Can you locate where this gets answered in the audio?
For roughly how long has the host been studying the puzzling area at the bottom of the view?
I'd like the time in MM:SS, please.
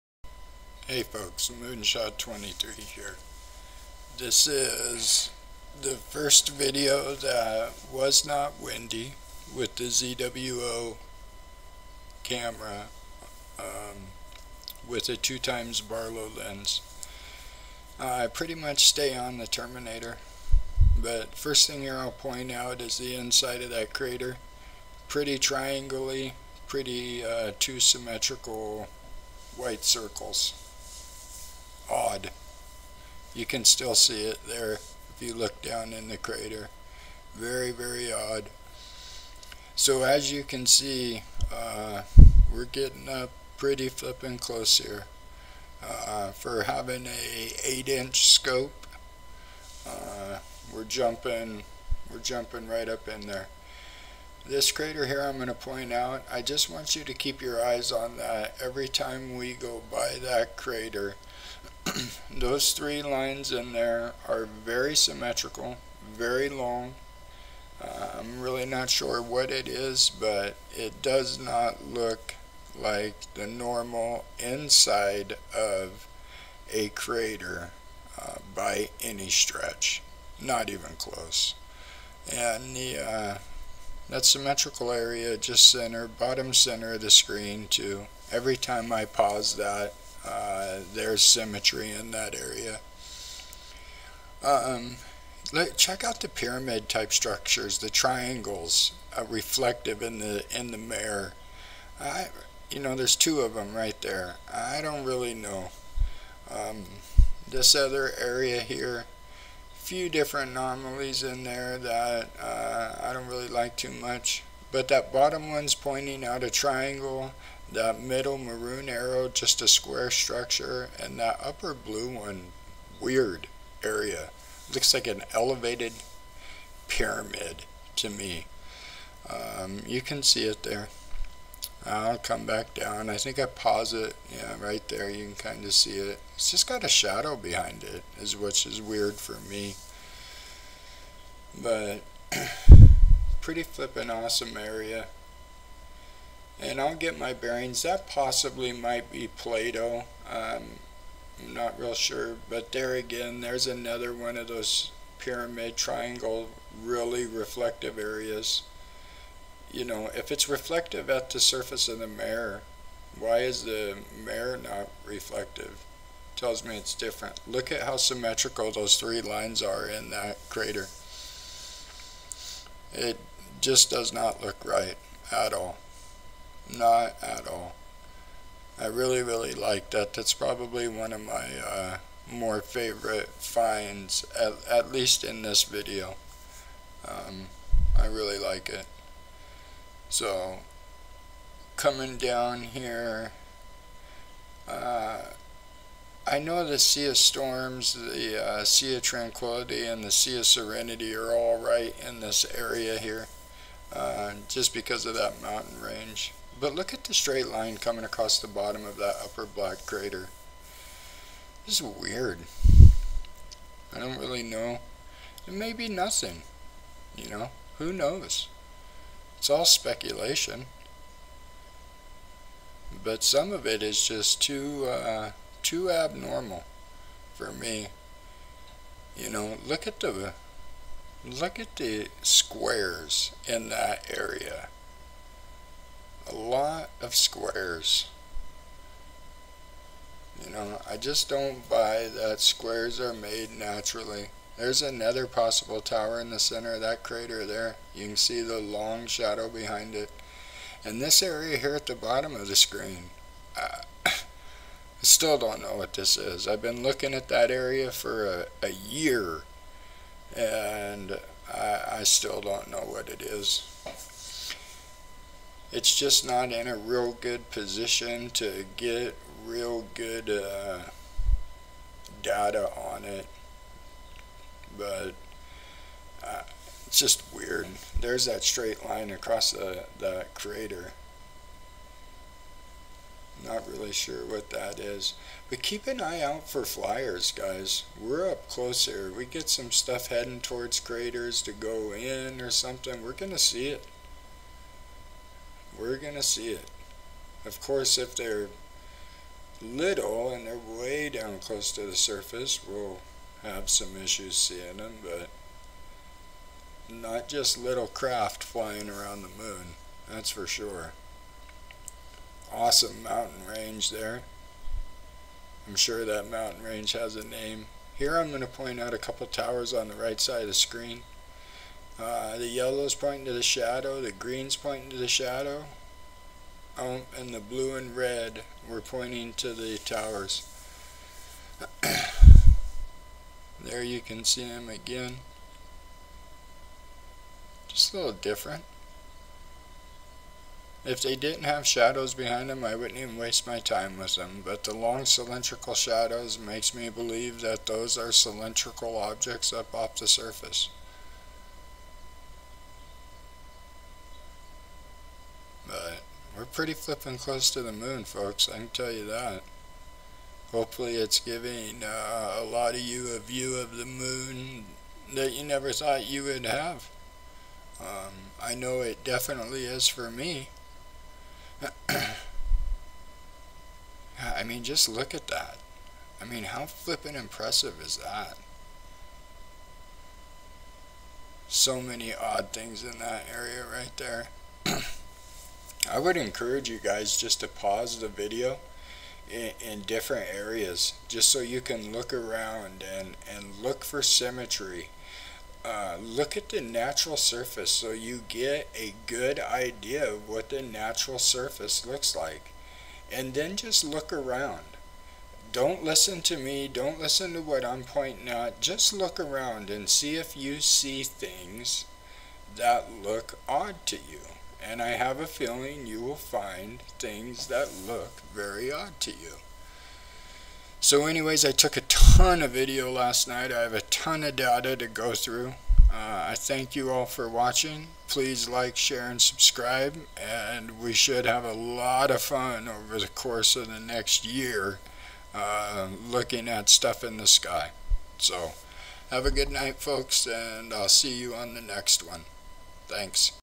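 04:18.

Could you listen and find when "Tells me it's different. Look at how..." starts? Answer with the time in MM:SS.
02:46.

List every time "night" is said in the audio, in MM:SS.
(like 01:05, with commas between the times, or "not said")
07:03, 07:19.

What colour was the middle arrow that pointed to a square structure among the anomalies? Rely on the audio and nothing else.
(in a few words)
maroon.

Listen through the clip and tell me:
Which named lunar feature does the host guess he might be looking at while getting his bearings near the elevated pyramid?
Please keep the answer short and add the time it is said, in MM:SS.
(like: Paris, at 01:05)
Plato, at 02:29.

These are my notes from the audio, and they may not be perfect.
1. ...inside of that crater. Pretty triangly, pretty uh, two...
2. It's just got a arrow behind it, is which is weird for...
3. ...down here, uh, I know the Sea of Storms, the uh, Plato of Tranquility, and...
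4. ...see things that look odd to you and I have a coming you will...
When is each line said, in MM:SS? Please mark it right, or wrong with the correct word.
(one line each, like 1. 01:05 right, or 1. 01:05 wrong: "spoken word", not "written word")
1. 00:23 right
2. 02:16 wrong: "shadow", not "arrow"
3. 03:12 wrong: "Sea", not "Plato"
4. 06:50 wrong: "feeling", not "coming".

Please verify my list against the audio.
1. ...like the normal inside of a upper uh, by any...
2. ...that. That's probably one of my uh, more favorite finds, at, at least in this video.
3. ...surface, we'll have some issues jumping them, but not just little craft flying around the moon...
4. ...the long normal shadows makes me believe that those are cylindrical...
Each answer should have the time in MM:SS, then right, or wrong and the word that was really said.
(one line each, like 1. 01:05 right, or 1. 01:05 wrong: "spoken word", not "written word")
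1. 01:12 wrong: "crater", not "upper"
2. 02:59 right
3. 05:01 wrong: "seeing", not "jumping"
4. 05:44 wrong: "cylindrical", not "normal".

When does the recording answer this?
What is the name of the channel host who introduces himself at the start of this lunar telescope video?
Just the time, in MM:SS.
00:01.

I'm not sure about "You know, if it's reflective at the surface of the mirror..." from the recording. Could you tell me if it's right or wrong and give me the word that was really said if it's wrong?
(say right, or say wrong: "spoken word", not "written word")
right.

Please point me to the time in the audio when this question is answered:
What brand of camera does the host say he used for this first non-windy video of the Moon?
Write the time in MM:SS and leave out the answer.
00:09.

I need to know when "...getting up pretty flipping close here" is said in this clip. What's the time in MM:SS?
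00:42.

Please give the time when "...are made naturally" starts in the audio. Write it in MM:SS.
04:02.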